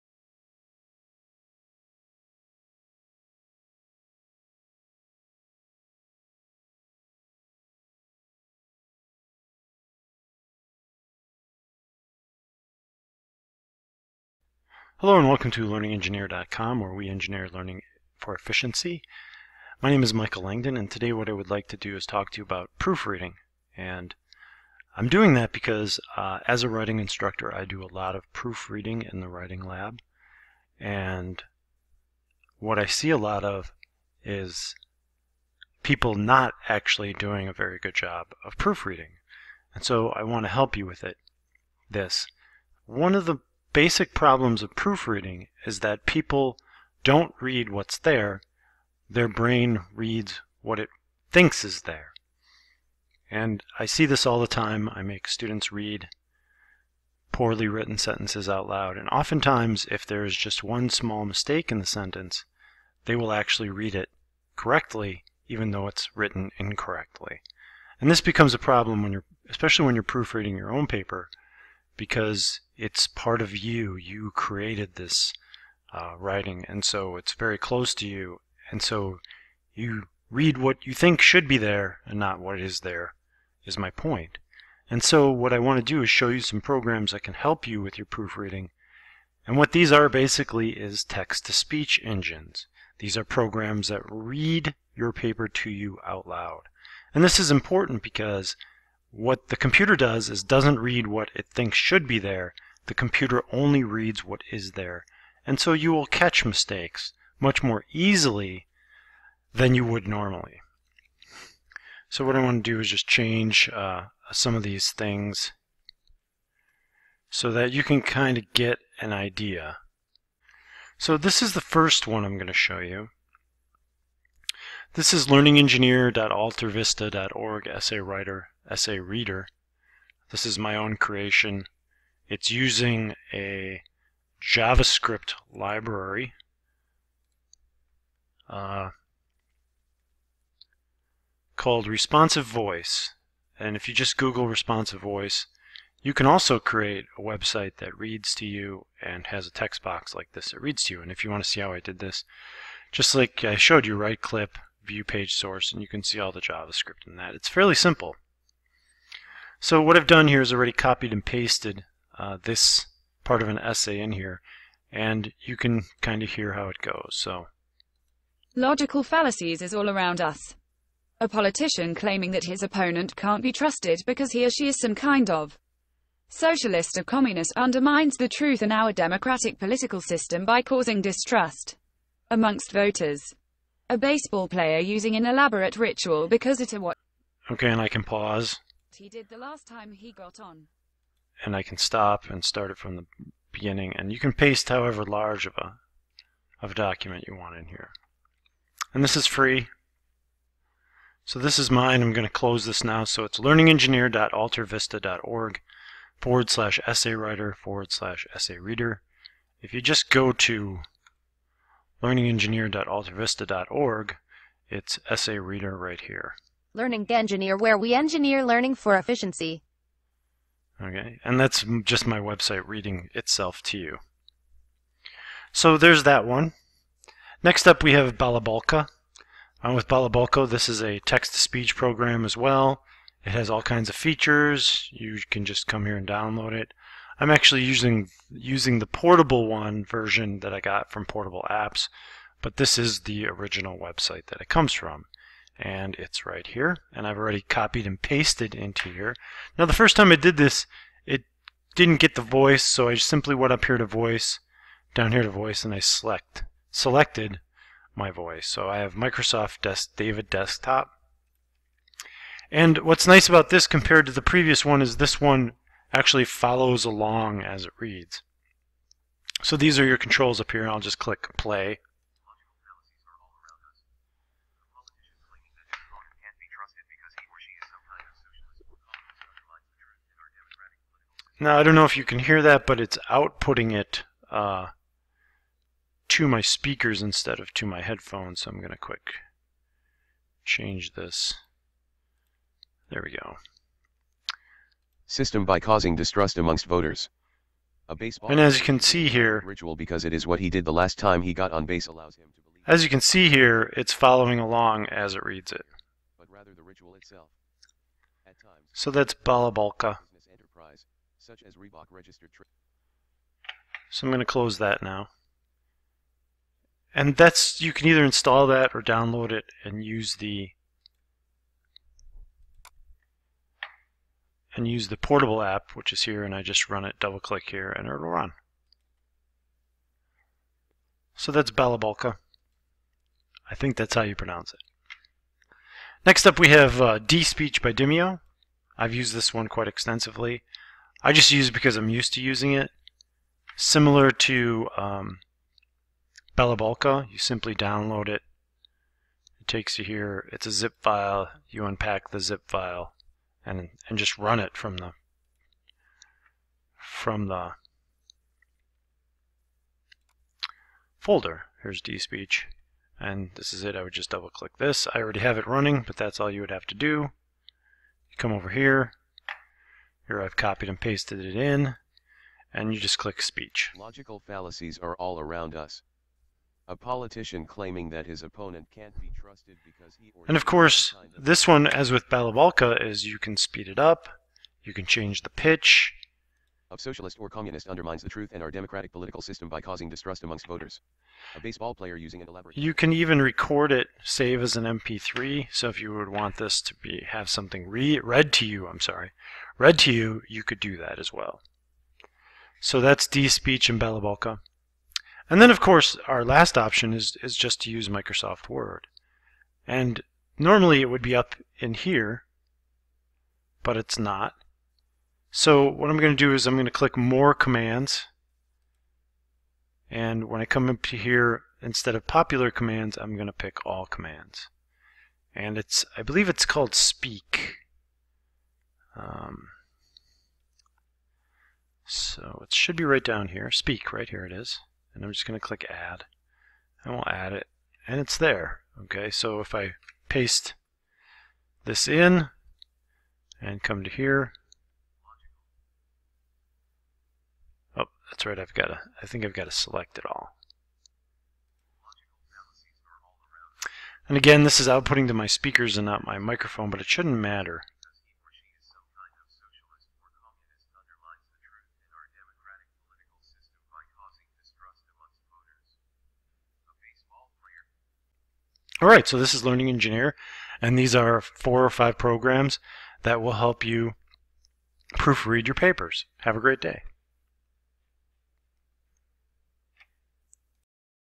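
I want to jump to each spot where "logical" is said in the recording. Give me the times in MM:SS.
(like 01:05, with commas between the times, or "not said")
02:48, 06:13.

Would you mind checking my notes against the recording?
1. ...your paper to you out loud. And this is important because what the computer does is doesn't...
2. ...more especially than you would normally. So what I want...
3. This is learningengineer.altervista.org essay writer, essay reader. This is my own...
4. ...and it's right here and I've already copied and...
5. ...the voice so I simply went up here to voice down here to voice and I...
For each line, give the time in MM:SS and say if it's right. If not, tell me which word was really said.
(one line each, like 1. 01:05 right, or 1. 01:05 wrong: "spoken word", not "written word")
1. 01:34 right
2. 01:47 wrong: "easily", not "especially"
3. 02:04 right
4. 04:05 right
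5. 04:12 right.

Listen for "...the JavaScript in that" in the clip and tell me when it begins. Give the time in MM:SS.
02:36.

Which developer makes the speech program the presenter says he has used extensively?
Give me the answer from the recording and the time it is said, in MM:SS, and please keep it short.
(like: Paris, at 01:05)
Dimio, at 05:37.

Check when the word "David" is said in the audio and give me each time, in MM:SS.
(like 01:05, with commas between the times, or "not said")
04:19.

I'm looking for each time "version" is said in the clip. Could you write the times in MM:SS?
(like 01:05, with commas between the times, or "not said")
03:59.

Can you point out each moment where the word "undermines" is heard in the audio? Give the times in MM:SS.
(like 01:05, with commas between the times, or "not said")
02:57, 06:27.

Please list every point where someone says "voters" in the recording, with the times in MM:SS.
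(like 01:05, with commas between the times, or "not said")
03:02, 04:56, 06:30.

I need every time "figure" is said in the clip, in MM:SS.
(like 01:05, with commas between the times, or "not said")
not said.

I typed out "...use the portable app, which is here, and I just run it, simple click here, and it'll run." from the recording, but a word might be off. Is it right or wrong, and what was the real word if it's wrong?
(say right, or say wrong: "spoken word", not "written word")
wrong: "double", not "simple".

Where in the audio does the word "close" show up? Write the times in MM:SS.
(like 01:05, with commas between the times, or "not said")
01:17, 03:22, 05:14.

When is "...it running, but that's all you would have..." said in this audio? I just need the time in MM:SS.
06:05.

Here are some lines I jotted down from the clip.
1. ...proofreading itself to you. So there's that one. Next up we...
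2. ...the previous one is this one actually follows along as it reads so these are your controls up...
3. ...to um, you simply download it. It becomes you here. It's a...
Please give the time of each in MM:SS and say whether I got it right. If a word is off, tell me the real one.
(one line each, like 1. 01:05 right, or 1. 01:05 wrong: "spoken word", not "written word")
1. 03:42 wrong: "reading", not "proofreading"
2. 04:24 right
3. 05:44 wrong: "takes", not "becomes".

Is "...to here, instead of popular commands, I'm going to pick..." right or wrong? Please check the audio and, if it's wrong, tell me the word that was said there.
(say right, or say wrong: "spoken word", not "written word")
right.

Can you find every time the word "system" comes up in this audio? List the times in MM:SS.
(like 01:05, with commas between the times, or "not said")
03:00, 04:55, 06:29.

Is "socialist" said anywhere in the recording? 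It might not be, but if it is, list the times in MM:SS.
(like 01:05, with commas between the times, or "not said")
02:56, 06:26.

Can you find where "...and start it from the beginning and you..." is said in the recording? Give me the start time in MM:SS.
03:12.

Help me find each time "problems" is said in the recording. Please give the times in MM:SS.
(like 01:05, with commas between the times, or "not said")
00:44, 01:08.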